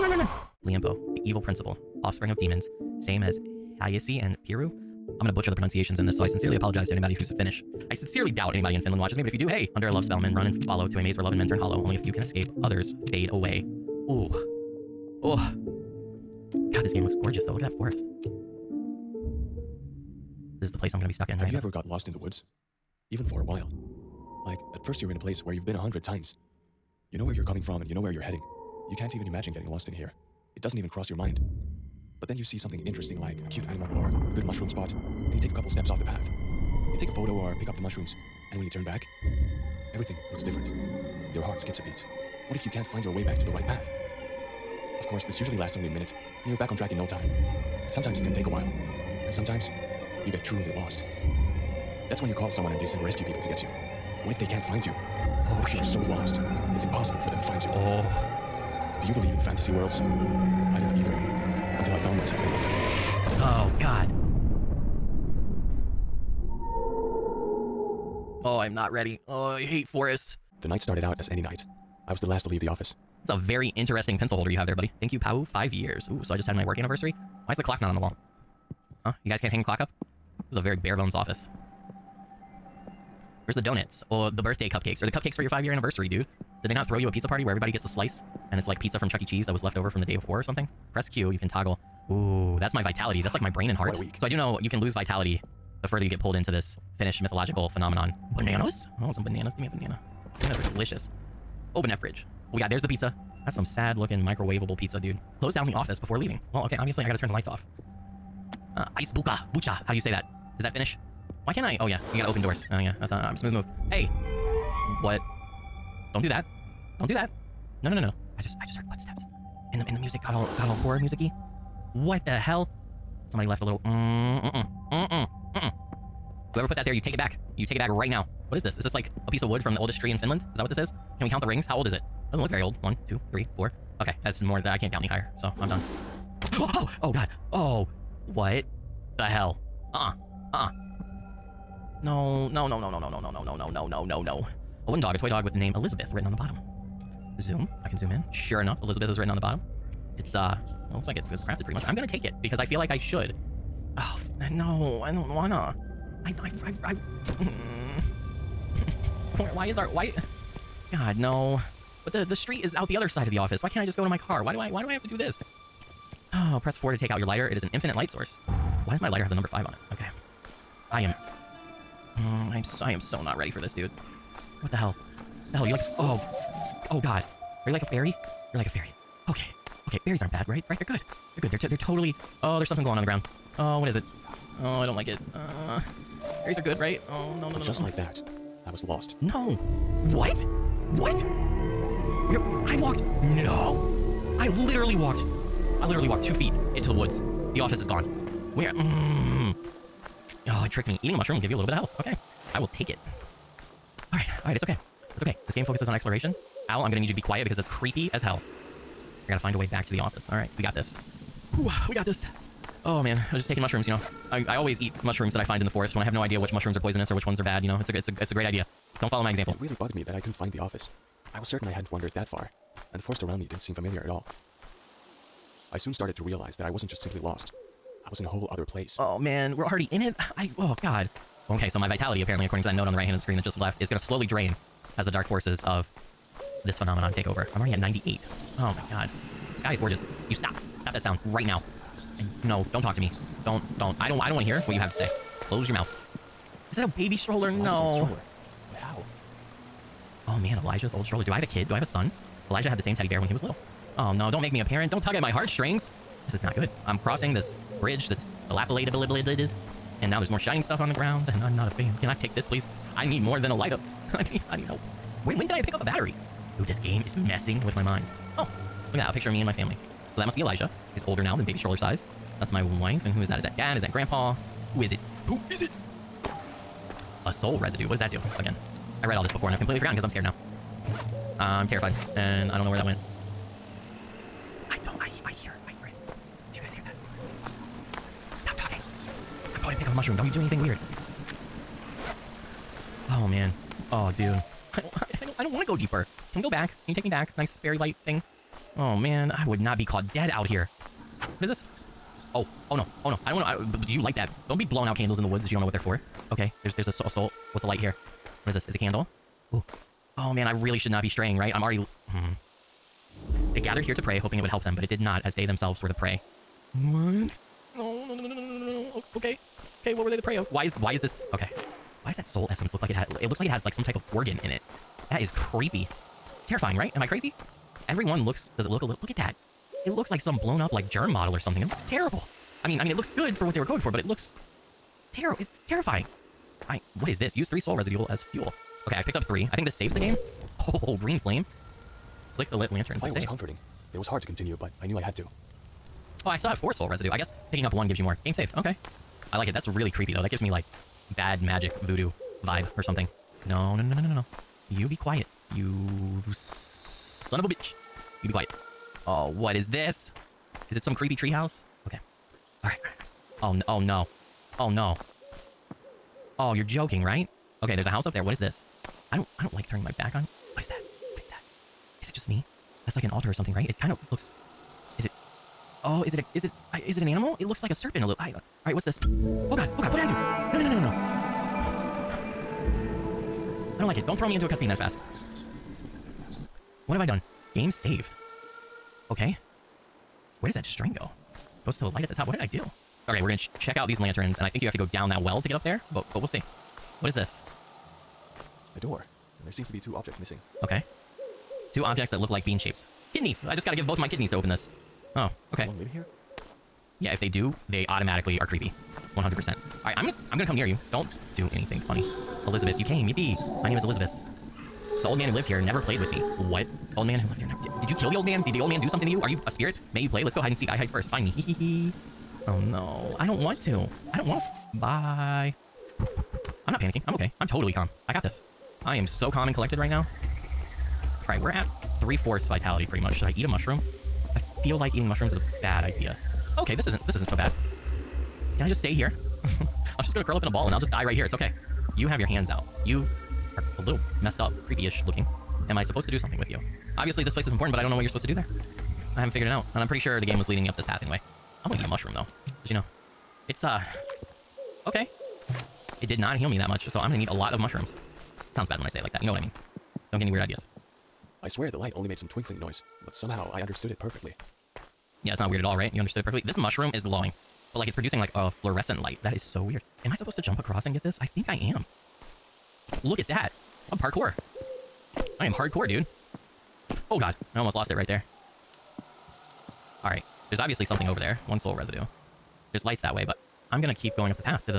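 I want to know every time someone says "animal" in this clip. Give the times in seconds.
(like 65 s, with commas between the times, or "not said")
33 s, 377 s.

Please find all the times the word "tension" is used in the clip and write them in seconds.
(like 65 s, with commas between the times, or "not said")
not said.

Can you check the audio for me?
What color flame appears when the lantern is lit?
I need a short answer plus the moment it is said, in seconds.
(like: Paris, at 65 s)
Green, at 340 s.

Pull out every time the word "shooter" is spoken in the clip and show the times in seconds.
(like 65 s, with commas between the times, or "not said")
not said.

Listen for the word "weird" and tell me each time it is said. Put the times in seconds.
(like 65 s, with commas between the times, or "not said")
290 s, 460 s, 465 s, 469 s.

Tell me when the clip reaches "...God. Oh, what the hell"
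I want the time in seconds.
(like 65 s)
137 s.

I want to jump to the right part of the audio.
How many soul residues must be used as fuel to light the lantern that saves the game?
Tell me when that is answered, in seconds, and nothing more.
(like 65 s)
337 s.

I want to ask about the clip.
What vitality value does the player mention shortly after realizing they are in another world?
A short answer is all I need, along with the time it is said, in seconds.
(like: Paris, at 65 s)
98, at 237 s.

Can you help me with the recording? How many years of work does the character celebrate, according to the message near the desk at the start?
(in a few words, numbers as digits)
5.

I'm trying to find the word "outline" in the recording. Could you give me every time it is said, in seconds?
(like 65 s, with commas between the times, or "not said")
not said.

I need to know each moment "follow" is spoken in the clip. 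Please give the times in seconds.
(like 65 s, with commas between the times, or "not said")
10 s, 219 s.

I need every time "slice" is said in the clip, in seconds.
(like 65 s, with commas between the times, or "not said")
87 s.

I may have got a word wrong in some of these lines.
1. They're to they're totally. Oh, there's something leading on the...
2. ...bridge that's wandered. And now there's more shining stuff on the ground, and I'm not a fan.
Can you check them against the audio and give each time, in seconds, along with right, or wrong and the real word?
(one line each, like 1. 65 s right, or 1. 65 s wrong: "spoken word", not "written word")
1. 181 s wrong: "glowing", not "leading"
2. 257 s wrong: "dilapidated", not "wandered".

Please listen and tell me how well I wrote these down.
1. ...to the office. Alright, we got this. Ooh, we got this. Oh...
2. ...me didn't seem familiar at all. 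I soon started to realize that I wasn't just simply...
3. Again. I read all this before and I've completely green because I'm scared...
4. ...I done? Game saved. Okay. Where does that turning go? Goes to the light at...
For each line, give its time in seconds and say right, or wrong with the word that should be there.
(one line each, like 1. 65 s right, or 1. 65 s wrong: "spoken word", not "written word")
1. 209 s right
2. 223 s right
3. 278 s wrong: "forgotten", not "green"
4. 387 s wrong: "string", not "turning".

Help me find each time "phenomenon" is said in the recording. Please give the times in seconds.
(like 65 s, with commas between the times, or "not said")
97 s, 236 s.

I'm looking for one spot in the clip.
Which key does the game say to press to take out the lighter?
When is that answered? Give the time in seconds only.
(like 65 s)
166 s.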